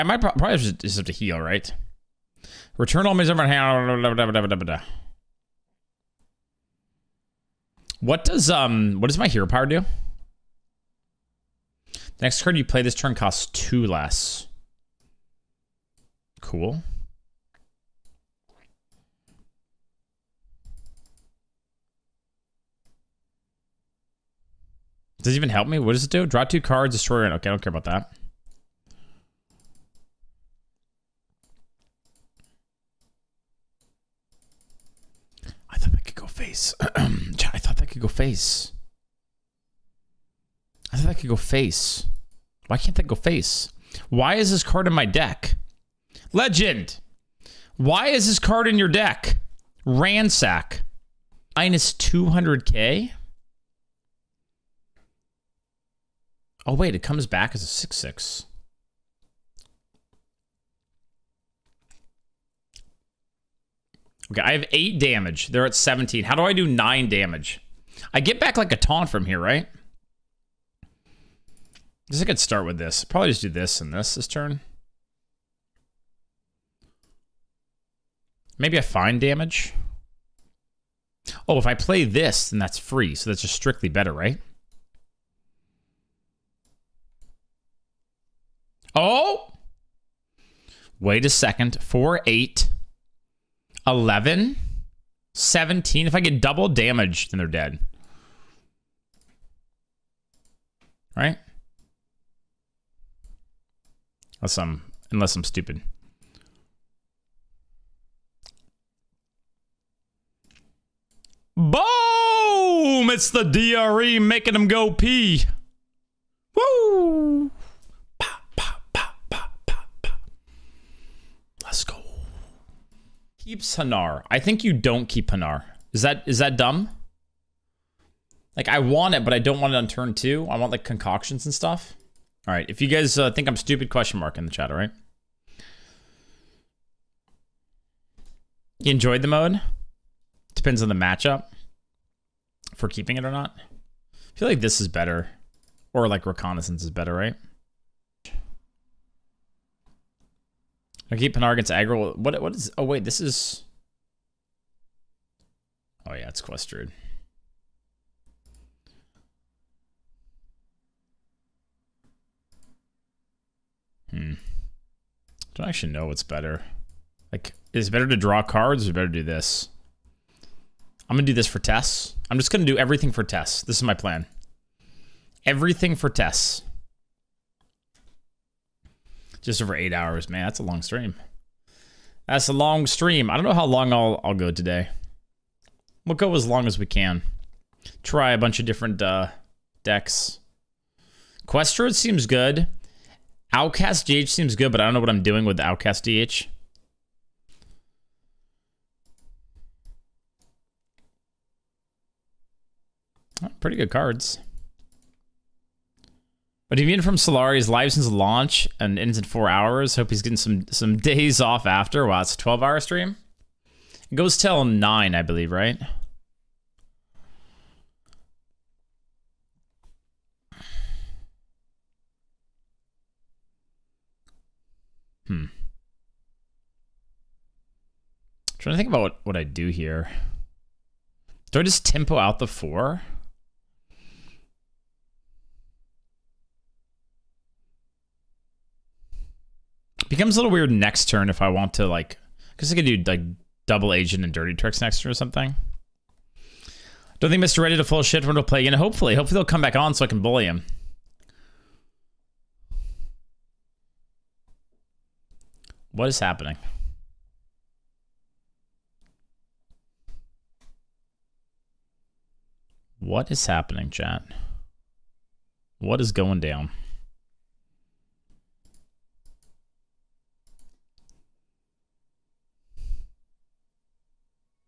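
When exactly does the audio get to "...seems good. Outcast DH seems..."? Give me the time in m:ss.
3:11.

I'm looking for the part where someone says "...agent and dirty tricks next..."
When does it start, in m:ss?
4:03.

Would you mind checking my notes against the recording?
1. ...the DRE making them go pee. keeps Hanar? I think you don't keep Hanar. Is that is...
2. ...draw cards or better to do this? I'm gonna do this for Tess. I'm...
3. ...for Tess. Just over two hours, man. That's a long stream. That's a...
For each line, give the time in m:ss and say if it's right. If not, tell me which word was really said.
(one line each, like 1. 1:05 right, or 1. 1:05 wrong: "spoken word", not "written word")
1. 1:53 right
2. 2:48 right
3. 2:55 wrong: "eight", not "two".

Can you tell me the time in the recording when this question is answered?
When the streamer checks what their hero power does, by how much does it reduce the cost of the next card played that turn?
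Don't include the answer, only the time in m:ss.
0:13.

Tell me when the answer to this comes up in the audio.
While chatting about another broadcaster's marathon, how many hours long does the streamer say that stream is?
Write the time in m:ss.
3:32.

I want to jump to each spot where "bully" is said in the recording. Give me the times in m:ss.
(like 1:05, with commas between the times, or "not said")
4:10.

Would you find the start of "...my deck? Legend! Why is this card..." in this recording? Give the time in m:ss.
0:44.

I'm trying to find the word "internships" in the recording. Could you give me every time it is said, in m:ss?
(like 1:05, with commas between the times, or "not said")
not said.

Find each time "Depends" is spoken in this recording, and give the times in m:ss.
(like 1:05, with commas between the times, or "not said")
2:20.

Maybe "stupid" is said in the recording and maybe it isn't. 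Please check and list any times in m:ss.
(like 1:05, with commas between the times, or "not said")
1:45, 2:13.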